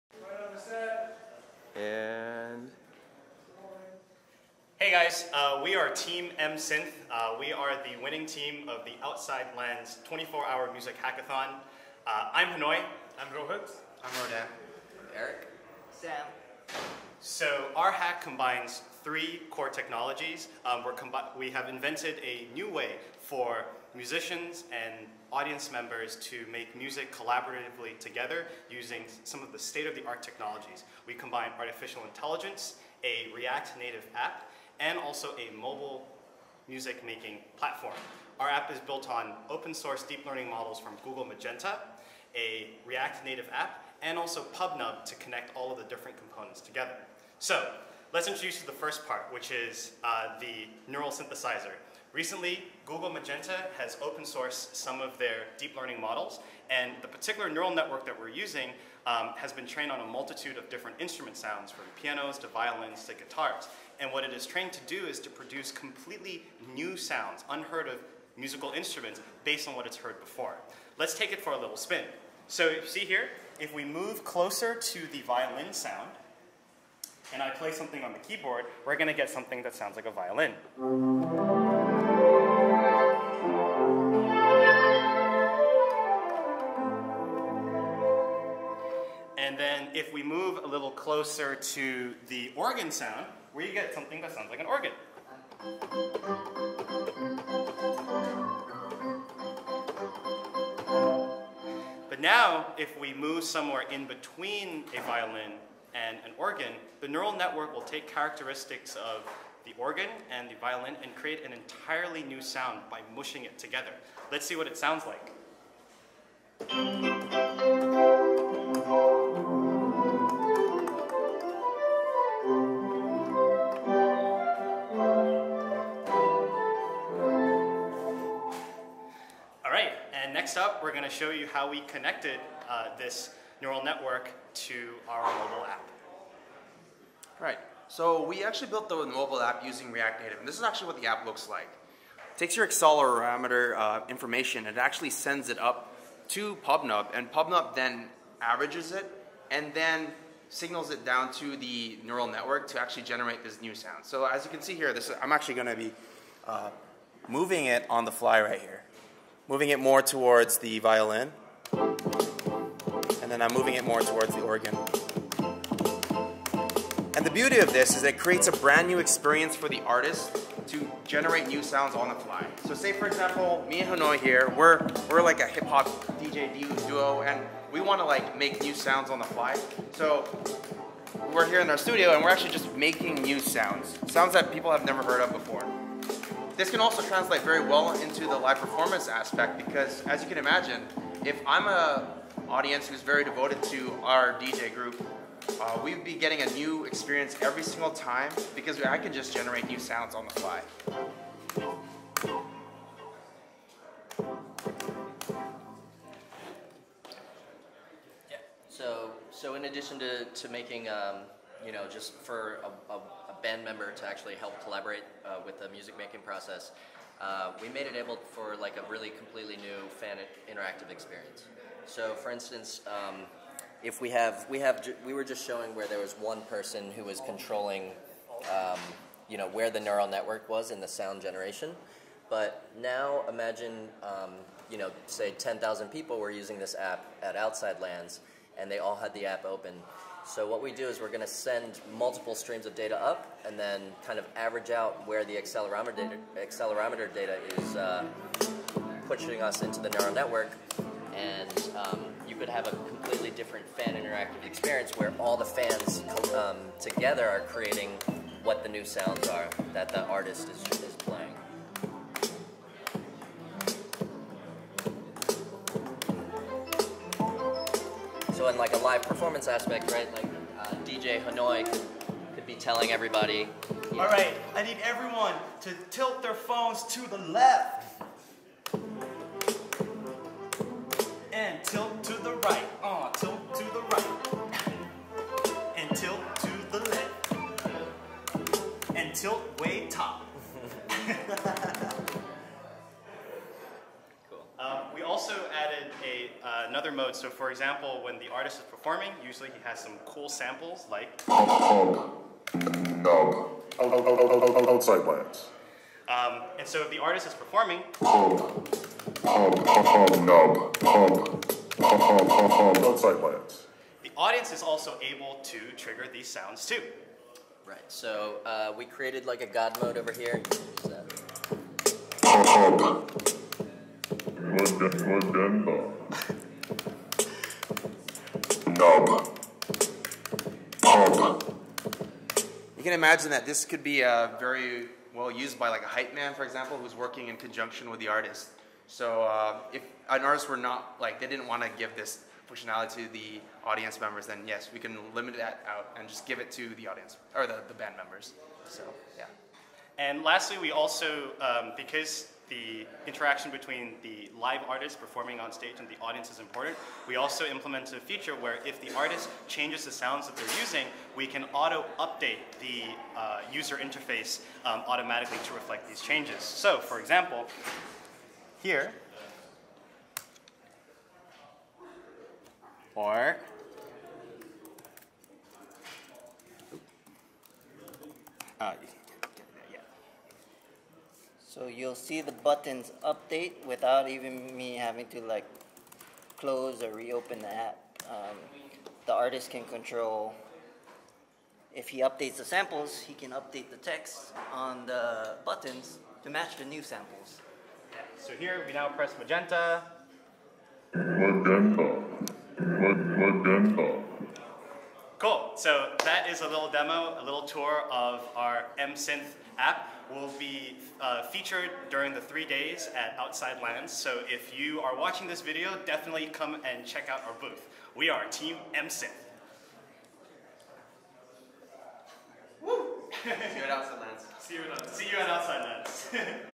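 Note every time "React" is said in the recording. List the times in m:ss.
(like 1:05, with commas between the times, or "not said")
0:33, 0:42, 2:19.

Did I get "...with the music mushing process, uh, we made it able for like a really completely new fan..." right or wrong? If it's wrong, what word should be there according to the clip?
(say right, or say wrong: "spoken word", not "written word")
wrong: "making", not "mushing".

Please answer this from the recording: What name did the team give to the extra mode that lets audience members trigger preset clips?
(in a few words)
god mode.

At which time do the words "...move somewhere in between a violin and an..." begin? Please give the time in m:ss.
1:43.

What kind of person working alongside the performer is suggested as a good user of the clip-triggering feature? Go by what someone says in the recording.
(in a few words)
hype man.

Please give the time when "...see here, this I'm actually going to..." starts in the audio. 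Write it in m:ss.
2:34.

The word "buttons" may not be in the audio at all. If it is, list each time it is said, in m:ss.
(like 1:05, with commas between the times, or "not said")
6:22, 6:35.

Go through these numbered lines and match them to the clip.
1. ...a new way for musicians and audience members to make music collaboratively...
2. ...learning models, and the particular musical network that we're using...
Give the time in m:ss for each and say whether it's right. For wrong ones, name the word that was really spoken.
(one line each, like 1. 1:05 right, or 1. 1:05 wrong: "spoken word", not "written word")
1. 0:22 right
2. 0:55 wrong: "neural", not "musical".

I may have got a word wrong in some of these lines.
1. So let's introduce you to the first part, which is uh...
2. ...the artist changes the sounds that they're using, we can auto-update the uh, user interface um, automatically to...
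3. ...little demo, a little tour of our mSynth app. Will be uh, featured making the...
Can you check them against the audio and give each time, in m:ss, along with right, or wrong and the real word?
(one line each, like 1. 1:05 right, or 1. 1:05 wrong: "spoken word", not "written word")
1. 0:47 right
2. 5:58 right
3. 6:46 wrong: "during", not "making".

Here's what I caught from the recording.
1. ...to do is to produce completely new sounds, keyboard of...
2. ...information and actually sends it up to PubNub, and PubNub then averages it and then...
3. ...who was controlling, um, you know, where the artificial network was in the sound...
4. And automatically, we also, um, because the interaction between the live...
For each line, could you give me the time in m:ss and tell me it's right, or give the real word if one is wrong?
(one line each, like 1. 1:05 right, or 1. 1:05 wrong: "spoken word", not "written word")
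1. 1:04 wrong: "unheard", not "keyboard"
2. 2:24 right
3. 3:46 wrong: "neural", not "artificial"
4. 5:49 wrong: "lastly", not "automatically".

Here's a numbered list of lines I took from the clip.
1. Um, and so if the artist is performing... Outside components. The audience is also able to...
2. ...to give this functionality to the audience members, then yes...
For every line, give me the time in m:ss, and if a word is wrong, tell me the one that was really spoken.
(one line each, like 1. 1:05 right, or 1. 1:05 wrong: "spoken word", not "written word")
1. 5:06 wrong: "plants", not "components"
2. 5:41 right.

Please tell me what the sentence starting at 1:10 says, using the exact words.
Let's take it for a little spin.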